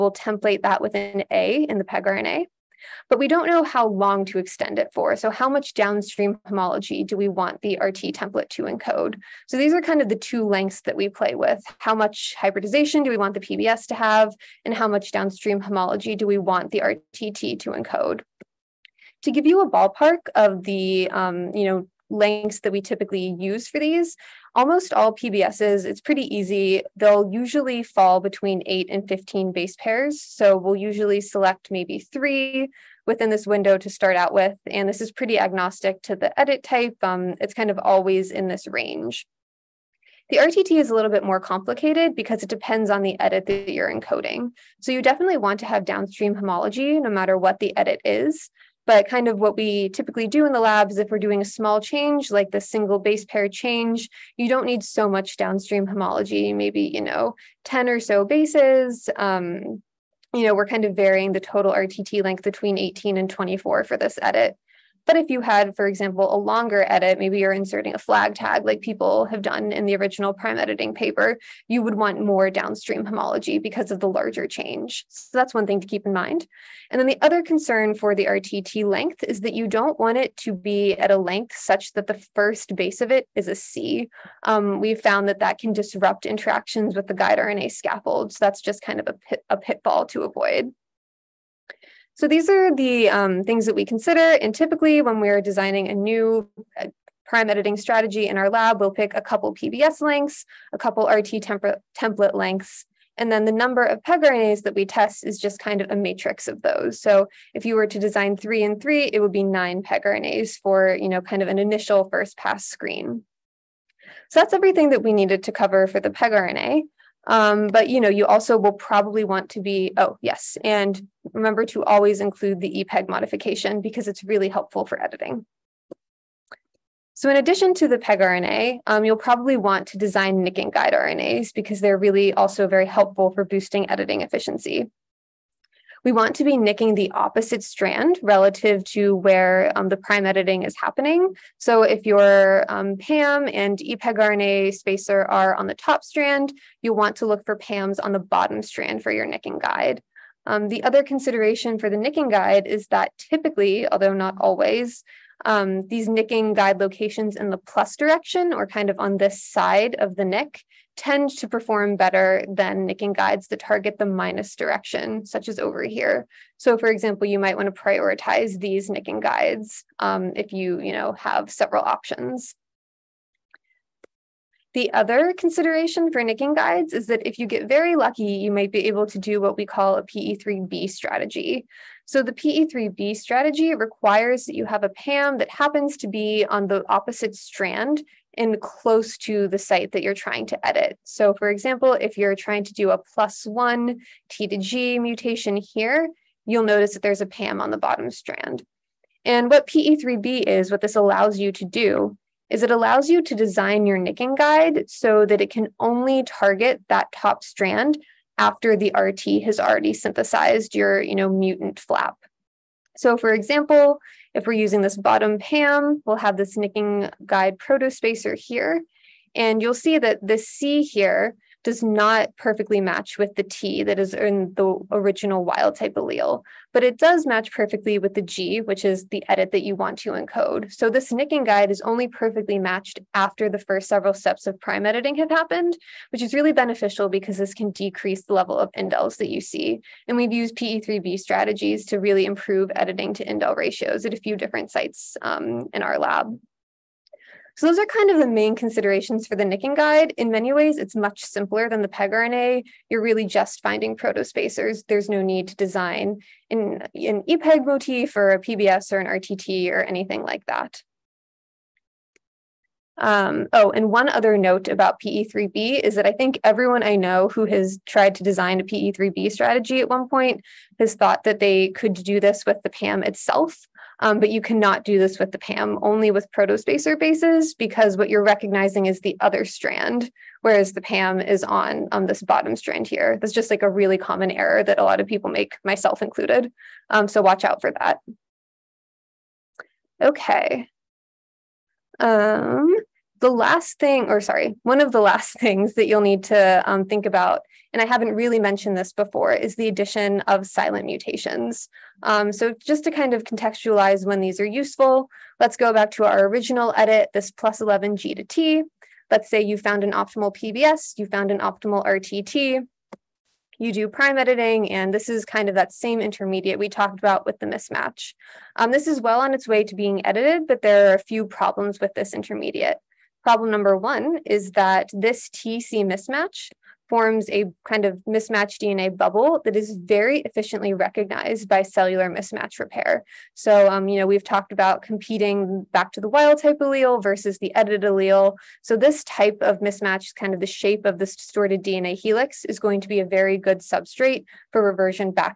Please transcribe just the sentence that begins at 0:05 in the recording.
So how much downstream homology do we want the RT template to encode?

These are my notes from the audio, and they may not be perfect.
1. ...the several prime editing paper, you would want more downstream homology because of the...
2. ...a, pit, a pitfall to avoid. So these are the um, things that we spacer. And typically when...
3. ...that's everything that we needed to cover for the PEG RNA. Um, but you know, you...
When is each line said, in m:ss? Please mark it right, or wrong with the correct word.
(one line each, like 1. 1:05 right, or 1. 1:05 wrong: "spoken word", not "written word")
1. 1:09 wrong: "original", not "several"
2. 1:29 wrong: "consider", not "spacer"
3. 1:54 right.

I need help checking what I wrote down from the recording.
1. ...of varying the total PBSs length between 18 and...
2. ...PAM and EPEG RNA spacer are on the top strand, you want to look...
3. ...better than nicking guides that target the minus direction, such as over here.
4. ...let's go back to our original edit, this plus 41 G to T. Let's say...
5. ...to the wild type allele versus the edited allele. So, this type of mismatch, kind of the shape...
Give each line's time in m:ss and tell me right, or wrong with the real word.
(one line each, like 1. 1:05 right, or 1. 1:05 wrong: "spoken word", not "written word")
1. 1:00 wrong: "RTT", not "PBSs"
2. 2:22 right
3. 2:41 right
4. 5:05 wrong: "11", not "41"
5. 5:35 right.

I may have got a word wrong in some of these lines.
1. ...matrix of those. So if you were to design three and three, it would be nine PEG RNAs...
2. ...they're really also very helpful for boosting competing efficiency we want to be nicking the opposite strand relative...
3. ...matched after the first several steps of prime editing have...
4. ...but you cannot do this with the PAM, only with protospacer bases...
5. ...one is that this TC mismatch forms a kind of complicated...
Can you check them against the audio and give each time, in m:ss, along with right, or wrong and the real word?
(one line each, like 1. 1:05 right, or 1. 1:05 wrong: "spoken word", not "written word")
1. 1:45 right
2. 2:11 wrong: "editing", not "competing"
3. 3:52 right
4. 4:34 right
5. 5:23 wrong: "mismatched", not "complicated".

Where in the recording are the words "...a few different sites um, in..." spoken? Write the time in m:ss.
4:04.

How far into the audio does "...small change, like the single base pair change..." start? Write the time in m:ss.
0:51.